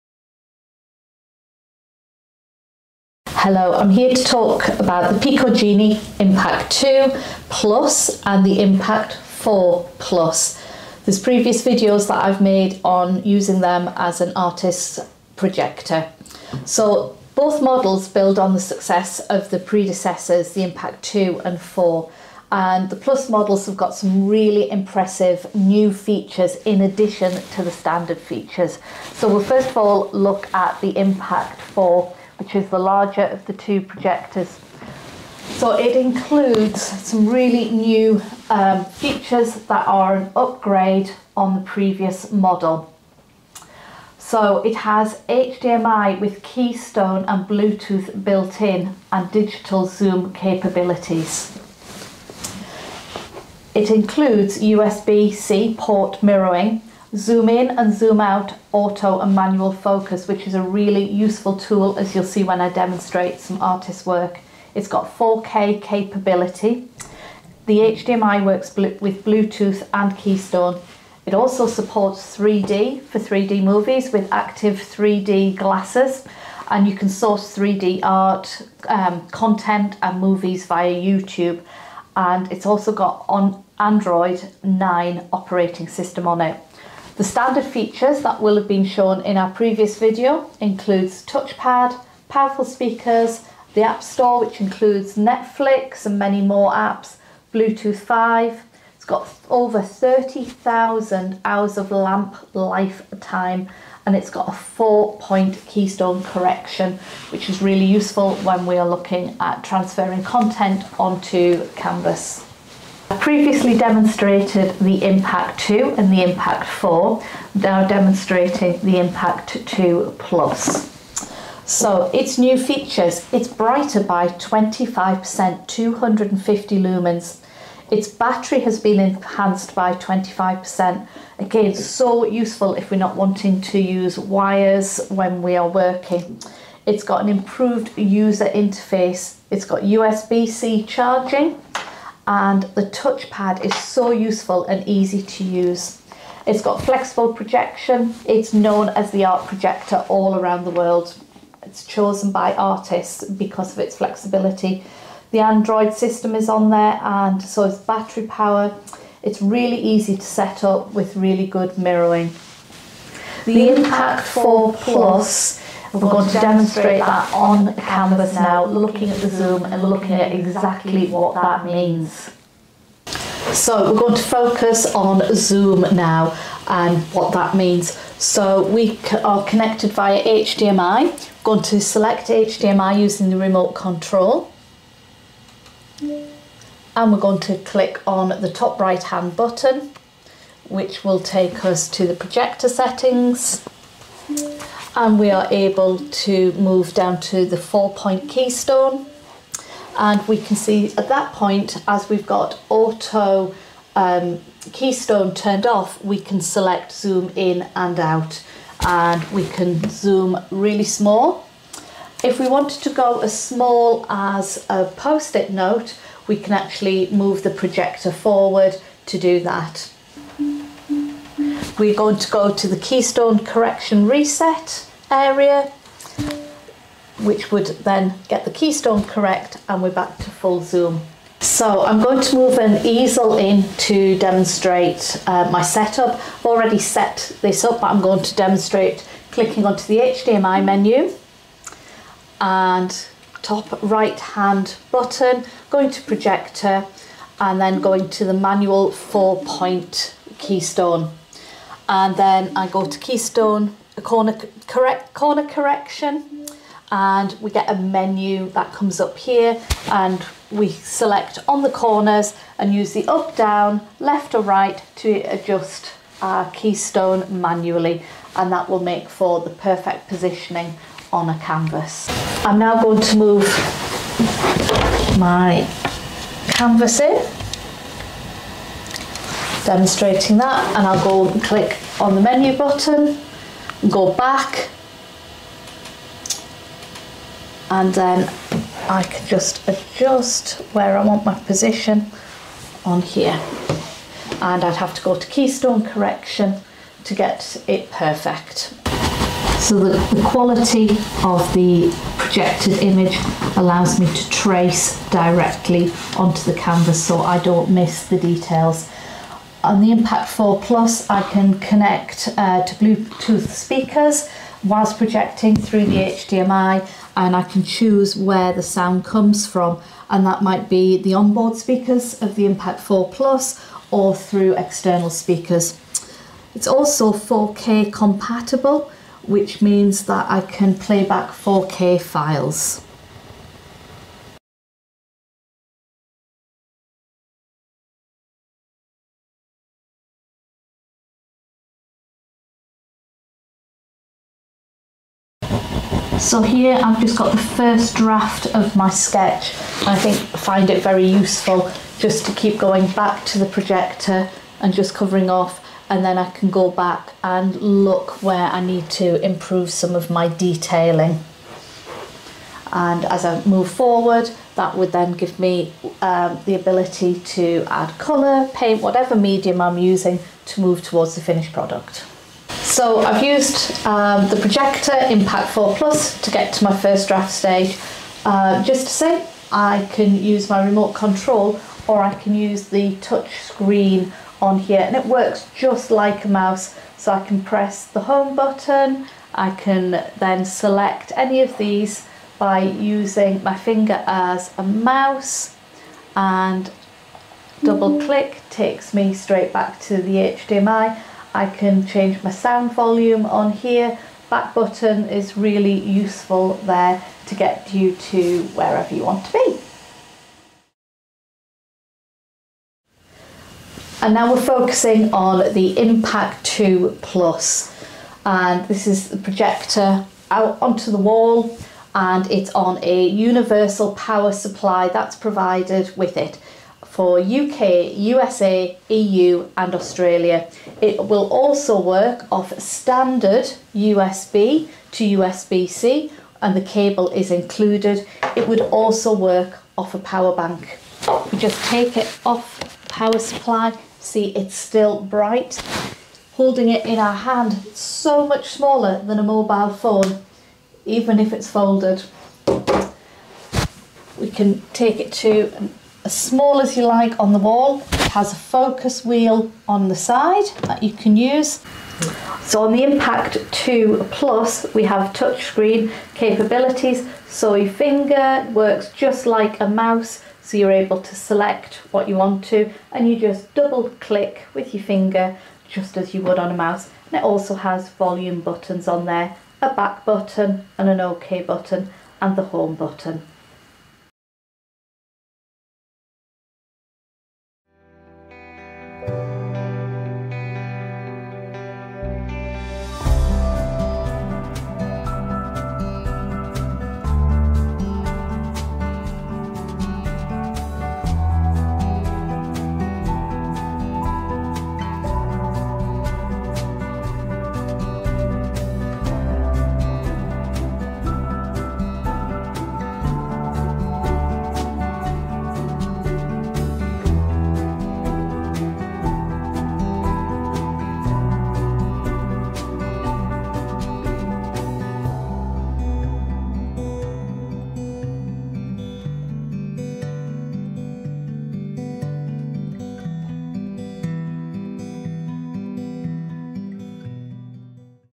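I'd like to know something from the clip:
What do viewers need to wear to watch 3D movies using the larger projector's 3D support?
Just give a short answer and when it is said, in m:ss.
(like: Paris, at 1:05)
Active 3D glasses, at 1:14.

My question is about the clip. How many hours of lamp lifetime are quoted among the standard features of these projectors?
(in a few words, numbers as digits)
Over 30,000 hours.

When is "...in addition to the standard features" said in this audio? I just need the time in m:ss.
0:26.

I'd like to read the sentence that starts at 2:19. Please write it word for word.
It's got USB-C charging and the touchpad is so useful and easy to use.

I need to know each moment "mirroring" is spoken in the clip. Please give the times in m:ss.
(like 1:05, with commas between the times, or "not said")
0:56, 2:41.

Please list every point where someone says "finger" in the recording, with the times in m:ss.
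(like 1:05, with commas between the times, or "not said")
6:33, 7:47, 7:54.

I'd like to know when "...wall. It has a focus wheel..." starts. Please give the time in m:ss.
7:37.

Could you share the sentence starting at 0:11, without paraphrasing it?
There's previous videos that I've made on using them as an artist's projector.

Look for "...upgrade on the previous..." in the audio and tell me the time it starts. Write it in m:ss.
0:40.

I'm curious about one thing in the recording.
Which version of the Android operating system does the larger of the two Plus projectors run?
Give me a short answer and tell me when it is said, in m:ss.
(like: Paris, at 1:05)
Android 9, at 1:23.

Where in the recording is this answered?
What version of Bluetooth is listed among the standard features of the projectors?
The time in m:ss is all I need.
1:37.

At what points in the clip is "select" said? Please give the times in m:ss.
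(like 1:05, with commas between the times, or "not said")
3:01, 3:26, 4:20, 6:30, 7:51.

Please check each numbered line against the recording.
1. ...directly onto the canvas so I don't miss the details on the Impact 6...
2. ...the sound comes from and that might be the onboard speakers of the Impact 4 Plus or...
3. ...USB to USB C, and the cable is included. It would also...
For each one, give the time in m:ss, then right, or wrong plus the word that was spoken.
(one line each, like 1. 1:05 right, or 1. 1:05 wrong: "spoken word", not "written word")
1. 5:05 wrong: "4", not "6"
2. 5:18 right
3. 7:13 right.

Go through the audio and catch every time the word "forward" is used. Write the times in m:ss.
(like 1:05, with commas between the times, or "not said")
3:38, 6:03.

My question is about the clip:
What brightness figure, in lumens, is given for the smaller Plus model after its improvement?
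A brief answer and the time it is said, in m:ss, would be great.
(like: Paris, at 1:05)
250 lumens, at 2:05.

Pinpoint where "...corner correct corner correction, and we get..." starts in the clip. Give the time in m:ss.
4:14.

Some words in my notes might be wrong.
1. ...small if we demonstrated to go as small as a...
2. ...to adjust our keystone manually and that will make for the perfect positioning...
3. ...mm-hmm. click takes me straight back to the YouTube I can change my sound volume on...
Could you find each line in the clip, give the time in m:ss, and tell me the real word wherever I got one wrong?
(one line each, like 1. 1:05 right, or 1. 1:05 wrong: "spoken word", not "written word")
1. 3:30 wrong: "wanted", not "demonstrated"
2. 4:24 right
3. 6:37 wrong: "HDMI", not "YouTube".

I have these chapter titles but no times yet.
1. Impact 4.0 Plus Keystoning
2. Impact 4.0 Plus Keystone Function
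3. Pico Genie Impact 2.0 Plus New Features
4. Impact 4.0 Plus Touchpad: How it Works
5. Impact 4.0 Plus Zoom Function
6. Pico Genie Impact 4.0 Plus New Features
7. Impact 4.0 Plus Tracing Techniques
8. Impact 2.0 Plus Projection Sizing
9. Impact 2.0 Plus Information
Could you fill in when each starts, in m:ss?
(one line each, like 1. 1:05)
1. 4:32
2. 3:50
3. 1:53
4. 6:12
5. 2:43
6. 0:32
7. 4:59
8. 7:32
9. 6:50.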